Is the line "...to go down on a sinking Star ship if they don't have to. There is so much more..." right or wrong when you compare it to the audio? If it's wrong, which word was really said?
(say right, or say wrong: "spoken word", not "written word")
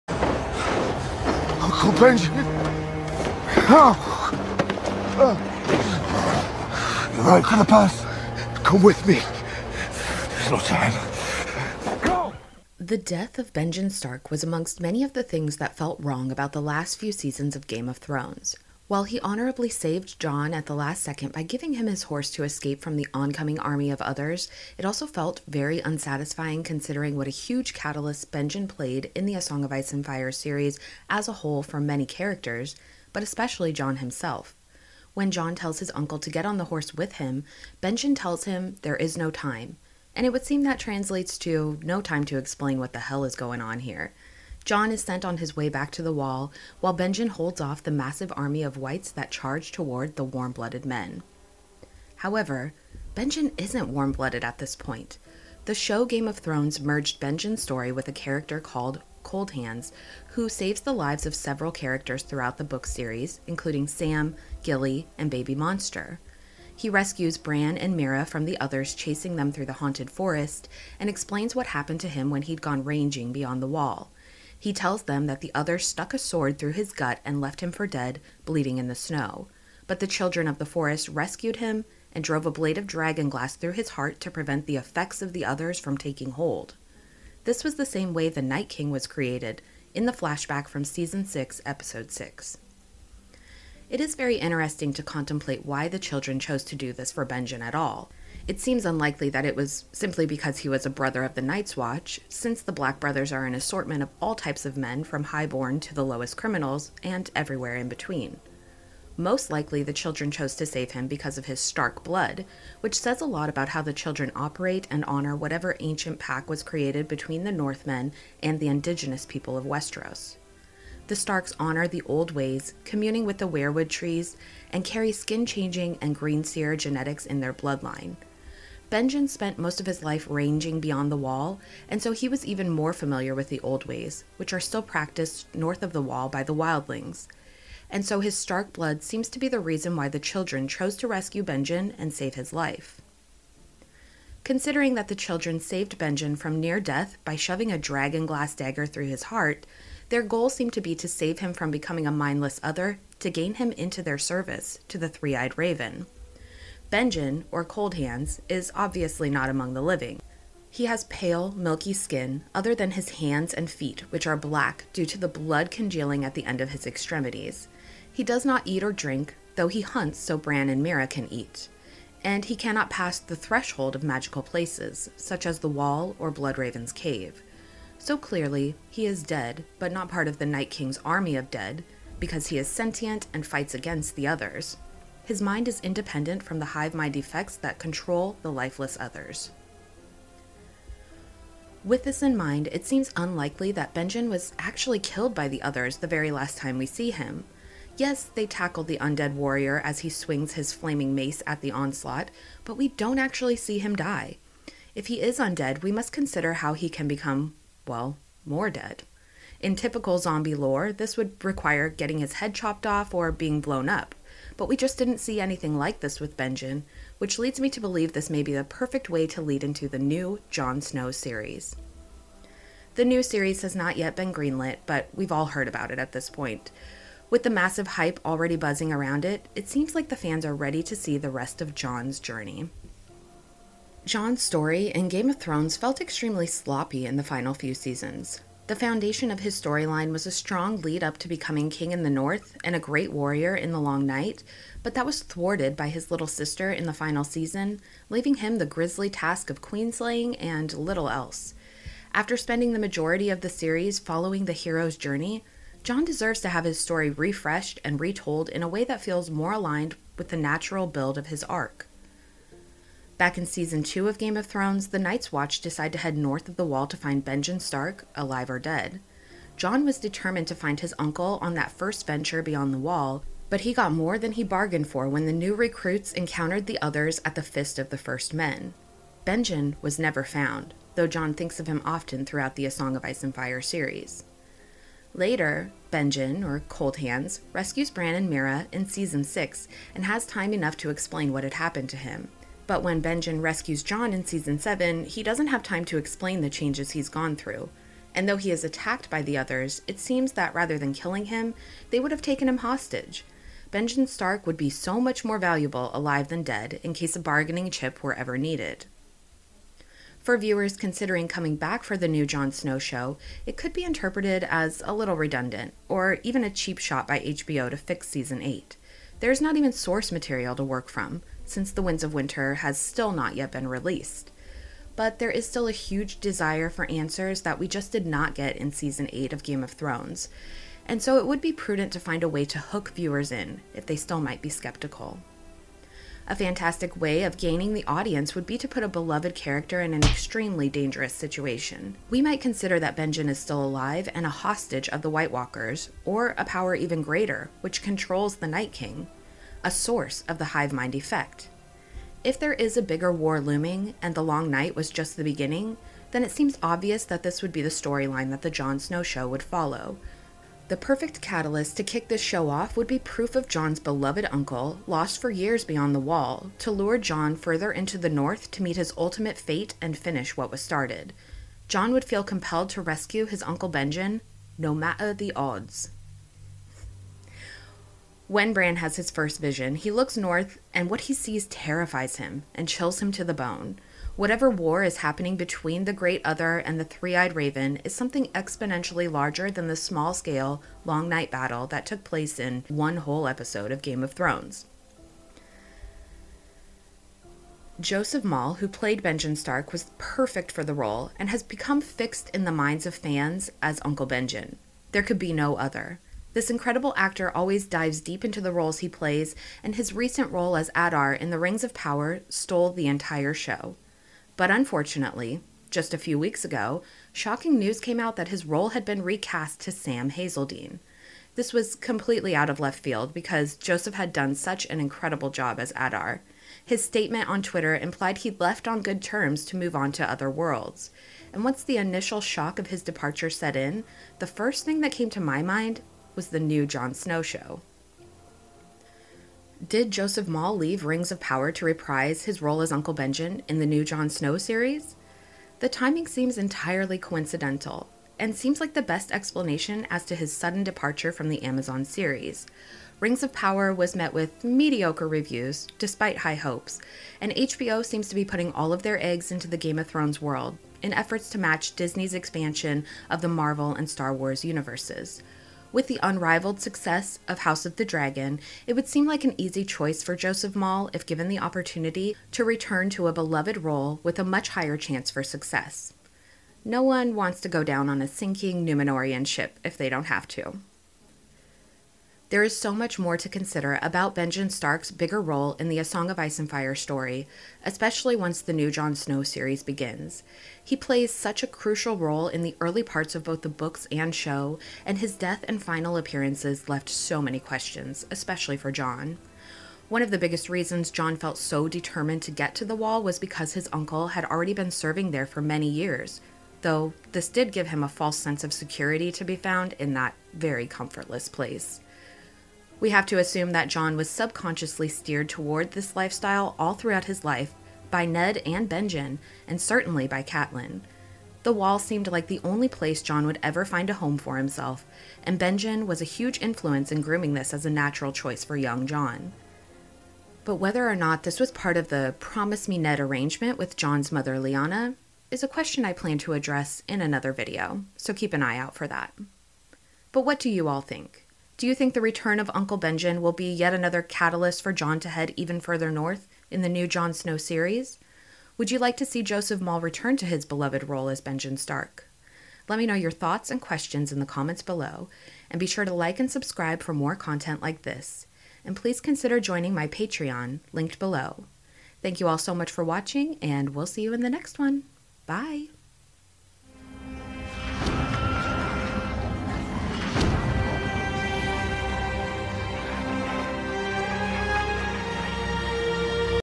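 wrong: "Numenorean", not "Star".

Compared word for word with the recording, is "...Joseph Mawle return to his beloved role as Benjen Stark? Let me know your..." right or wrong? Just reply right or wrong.
right.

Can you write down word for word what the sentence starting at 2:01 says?
The Starks honor the old ways, communing with the weirwood trees, and carry skin changing and green seer genetics in their bloodline.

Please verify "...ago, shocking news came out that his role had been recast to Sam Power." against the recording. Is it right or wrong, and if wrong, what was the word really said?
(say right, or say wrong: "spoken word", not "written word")
wrong: "Hazeldine", not "Power".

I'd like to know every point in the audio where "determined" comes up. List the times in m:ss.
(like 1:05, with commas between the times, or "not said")
4:29, 8:21.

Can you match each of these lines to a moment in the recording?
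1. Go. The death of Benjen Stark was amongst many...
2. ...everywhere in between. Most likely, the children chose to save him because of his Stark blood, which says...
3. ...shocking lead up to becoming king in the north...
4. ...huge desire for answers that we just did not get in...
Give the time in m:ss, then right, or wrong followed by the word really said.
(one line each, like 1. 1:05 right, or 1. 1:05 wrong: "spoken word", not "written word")
1. 0:12 right
2. 1:47 right
3. 4:00 wrong: "strong", not "shocking"
4. 5:25 right.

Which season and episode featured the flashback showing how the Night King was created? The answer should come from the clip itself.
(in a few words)
season 6, episode 6.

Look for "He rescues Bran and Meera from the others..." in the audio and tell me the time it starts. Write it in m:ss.
1:06.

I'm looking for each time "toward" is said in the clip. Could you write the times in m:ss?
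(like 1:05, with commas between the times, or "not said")
0:49, 8:35.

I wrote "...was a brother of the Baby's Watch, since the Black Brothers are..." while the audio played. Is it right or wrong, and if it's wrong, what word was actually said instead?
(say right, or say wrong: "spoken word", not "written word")
wrong: "Night", not "Baby".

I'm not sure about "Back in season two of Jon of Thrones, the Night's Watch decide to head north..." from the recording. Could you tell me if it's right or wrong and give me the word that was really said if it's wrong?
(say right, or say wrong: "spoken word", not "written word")
wrong: "Game", not "Jon".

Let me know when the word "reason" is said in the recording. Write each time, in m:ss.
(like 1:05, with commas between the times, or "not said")
2:19, 8:20.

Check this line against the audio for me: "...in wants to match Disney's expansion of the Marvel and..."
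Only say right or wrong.
wrong.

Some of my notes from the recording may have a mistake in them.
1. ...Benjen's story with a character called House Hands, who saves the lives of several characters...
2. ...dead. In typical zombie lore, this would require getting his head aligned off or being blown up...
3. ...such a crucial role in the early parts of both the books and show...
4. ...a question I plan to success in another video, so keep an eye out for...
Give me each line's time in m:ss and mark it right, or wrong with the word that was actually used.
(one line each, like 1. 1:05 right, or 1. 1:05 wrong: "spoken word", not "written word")
1. 0:57 wrong: "Cold", not "House"
2. 3:28 wrong: "chopped", not "aligned"
3. 8:11 right
4. 8:55 wrong: "address", not "success".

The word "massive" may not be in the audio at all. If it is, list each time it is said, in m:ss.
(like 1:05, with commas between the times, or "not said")
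0:47, 3:47.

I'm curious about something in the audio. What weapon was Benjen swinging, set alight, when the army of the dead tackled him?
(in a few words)
flaming mace.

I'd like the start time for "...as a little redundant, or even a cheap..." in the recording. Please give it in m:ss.
5:14.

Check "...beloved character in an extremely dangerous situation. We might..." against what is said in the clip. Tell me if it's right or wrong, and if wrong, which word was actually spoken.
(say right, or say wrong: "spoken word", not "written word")
right.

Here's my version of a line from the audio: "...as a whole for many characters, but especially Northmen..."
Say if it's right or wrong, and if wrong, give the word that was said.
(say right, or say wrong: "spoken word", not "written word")
wrong: "Jon", not "Northmen".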